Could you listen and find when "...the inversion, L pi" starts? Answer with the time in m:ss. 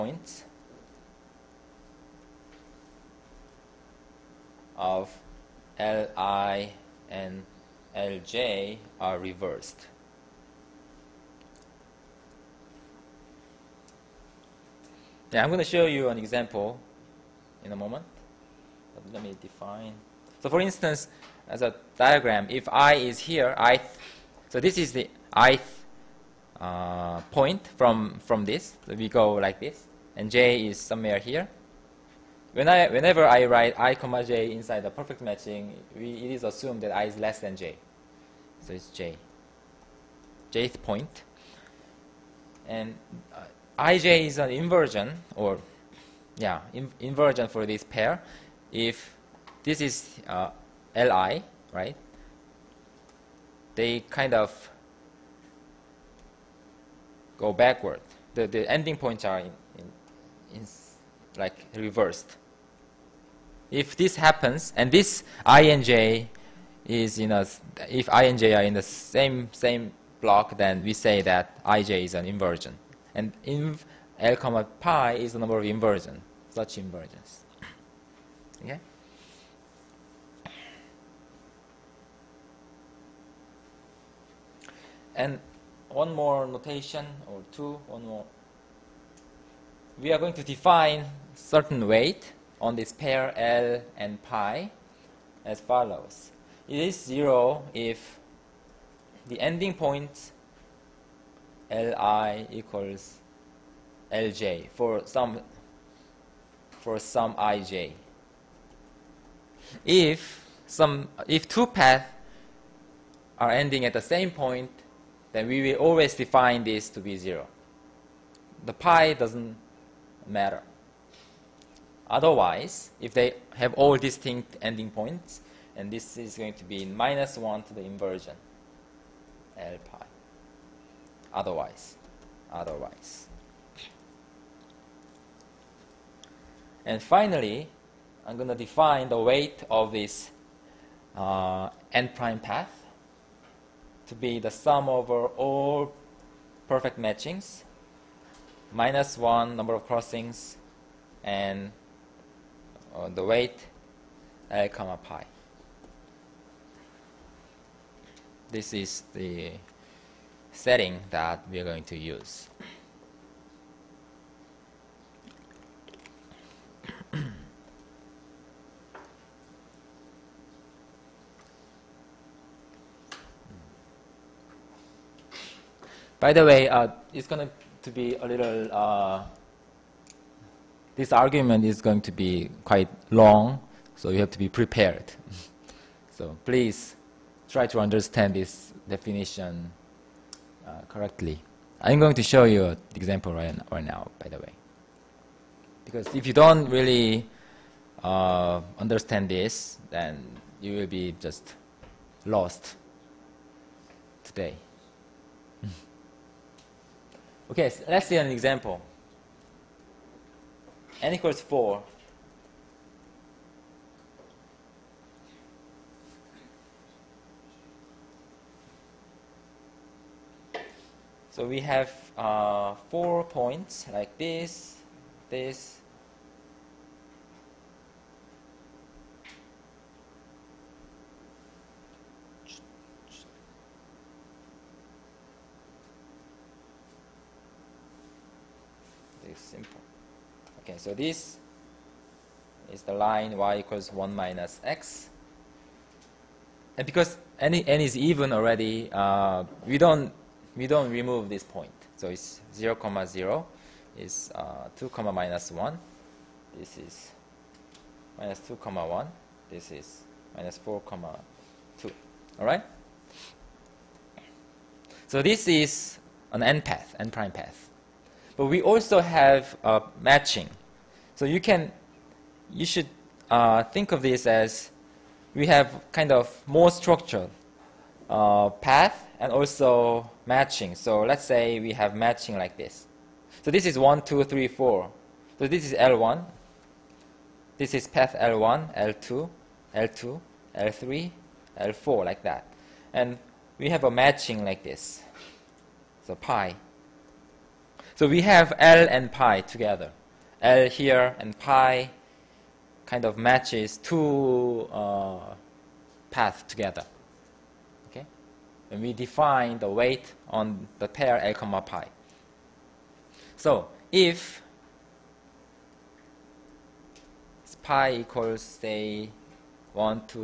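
2:07.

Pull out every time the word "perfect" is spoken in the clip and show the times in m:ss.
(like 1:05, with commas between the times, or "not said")
0:34, 2:26.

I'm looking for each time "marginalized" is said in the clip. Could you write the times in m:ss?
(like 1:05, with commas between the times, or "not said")
not said.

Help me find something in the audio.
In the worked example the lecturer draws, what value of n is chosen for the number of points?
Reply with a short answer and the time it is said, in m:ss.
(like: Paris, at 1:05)
4, at 3:31.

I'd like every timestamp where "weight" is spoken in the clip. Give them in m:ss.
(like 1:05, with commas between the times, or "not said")
1:31, 2:19, 2:33, 5:09.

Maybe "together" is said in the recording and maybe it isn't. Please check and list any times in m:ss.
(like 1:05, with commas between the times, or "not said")
4:59, 5:06.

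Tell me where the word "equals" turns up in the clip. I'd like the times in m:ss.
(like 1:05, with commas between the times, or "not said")
1:42, 3:31, 4:03, 5:17.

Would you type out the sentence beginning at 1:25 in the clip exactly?
And one more notation or two, one more.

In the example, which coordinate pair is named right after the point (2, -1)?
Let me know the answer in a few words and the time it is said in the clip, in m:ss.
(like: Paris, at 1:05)
(-2, 1), at 4:18.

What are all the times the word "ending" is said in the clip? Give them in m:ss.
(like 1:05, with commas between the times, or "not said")
0:58, 1:39, 1:53, 2:04.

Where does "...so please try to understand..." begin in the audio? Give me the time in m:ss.
3:06.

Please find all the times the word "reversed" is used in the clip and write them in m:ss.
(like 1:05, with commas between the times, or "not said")
0:09, 1:01.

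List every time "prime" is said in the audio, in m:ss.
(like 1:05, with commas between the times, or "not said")
2:22, 4:27.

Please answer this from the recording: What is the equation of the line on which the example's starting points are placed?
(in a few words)
y = 1 - x.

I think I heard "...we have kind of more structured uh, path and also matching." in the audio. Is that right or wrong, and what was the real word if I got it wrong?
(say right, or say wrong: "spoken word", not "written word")
right.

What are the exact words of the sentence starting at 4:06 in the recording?
And because n, n is even already, uh, we, don't, we don't remove this point.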